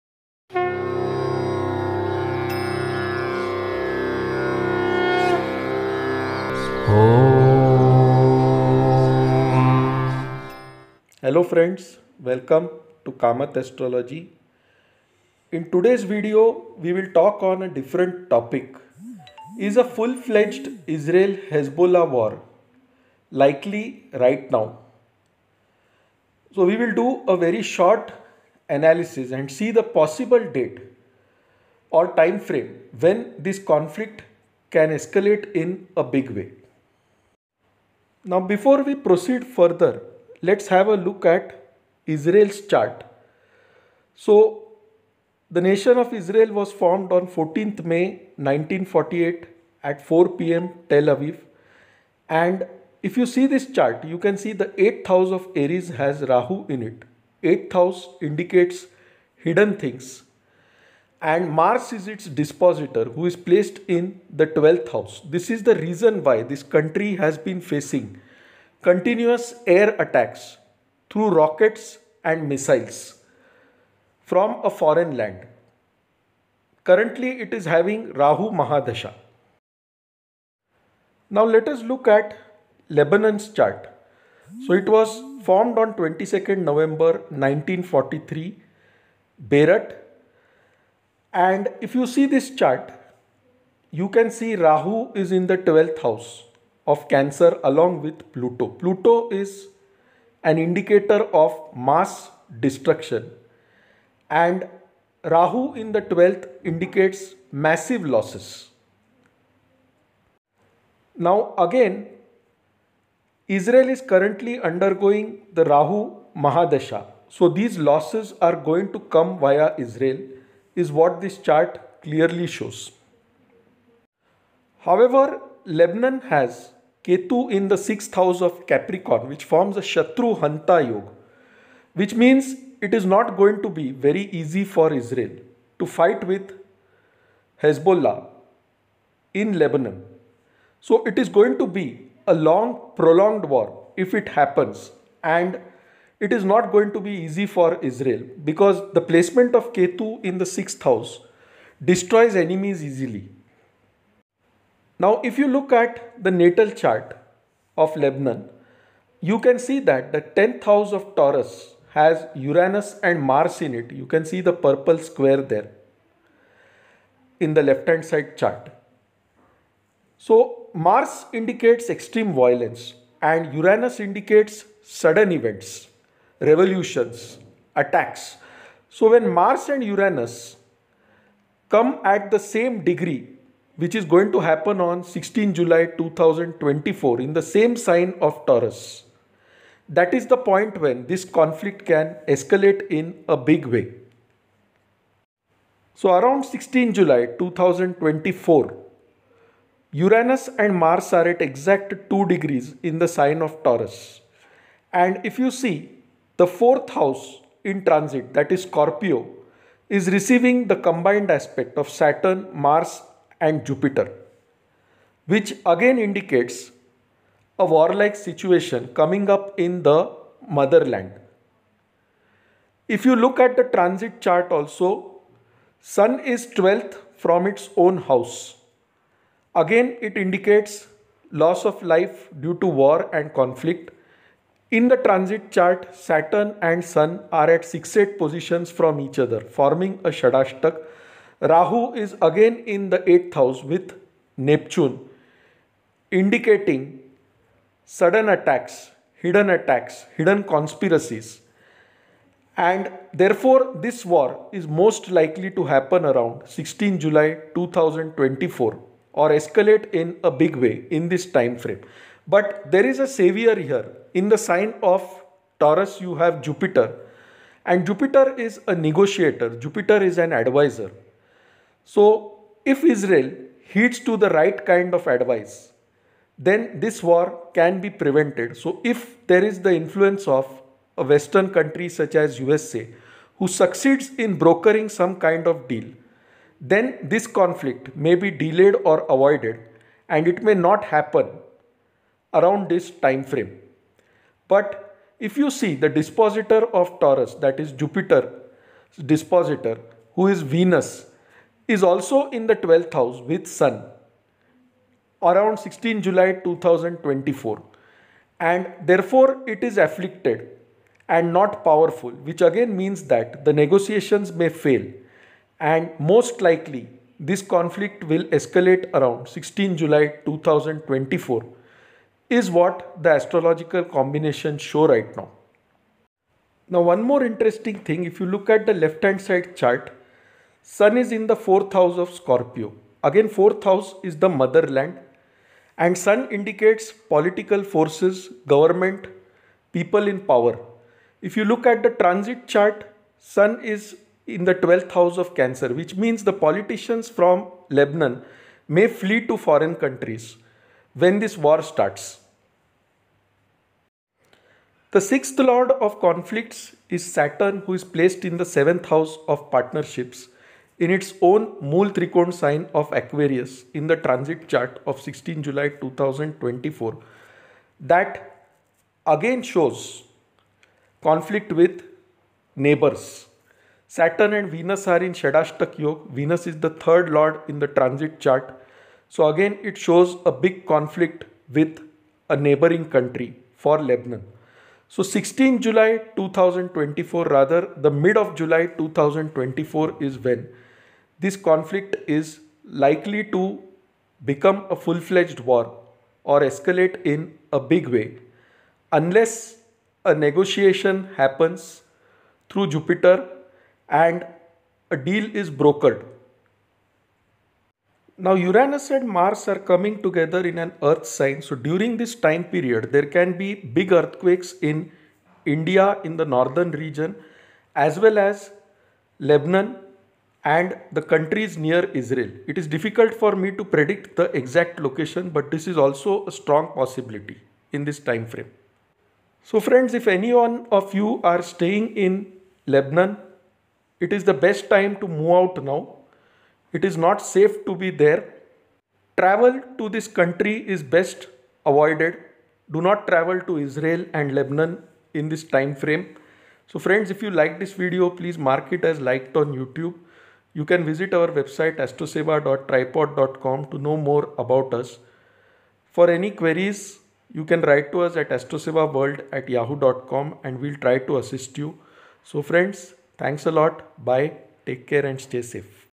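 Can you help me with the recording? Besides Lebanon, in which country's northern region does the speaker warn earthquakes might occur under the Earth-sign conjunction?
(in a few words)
India.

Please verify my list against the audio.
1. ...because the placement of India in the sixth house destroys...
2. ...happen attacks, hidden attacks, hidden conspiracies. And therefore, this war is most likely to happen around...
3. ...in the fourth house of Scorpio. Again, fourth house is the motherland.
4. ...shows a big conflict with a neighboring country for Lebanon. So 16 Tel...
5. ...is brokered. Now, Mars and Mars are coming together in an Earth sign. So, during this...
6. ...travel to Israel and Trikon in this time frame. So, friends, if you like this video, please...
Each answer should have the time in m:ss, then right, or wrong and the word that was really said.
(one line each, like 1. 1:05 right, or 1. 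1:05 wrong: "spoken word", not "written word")
1. 2:28 wrong: "Ketu", not "India"
2. 4:07 wrong: "sudden", not "happen"
3. 5:31 right
4. 6:19 wrong: "July", not "Tel"
5. 6:45 wrong: "Uranus", not "Mars"
6. 7:23 wrong: "Lebanon", not "Trikon".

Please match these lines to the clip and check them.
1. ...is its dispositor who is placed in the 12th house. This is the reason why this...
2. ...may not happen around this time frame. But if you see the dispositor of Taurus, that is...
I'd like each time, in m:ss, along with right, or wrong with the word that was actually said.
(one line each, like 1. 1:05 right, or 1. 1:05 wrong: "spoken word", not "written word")
1. 1:01 right
2. 4:50 right.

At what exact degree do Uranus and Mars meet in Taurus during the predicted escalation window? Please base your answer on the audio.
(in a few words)
2 degrees.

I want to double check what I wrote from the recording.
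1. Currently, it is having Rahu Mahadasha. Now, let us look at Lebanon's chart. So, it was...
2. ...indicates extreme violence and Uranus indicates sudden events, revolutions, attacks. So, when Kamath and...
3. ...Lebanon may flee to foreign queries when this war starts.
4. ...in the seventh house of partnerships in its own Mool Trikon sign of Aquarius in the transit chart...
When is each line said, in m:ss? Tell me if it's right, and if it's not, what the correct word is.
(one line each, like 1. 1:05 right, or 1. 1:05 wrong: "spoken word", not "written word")
1. 1:16 right
2. 2:51 wrong: "Mars", not "Kamath"
3. 5:47 wrong: "countries", not "queries"
4. 5:58 right.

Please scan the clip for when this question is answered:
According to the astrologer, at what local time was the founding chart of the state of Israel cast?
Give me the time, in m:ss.
0:50.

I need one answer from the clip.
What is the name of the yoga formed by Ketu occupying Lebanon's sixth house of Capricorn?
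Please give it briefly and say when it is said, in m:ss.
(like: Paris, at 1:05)
Shatru Hanta Yoga, at 2:09.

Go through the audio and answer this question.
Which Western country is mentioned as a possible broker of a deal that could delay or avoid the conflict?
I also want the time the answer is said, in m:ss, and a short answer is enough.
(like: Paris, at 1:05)
USA, at 4:42.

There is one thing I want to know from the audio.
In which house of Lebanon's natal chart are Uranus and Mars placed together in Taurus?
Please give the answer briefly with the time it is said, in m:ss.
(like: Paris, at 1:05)
10th house, at 2:40.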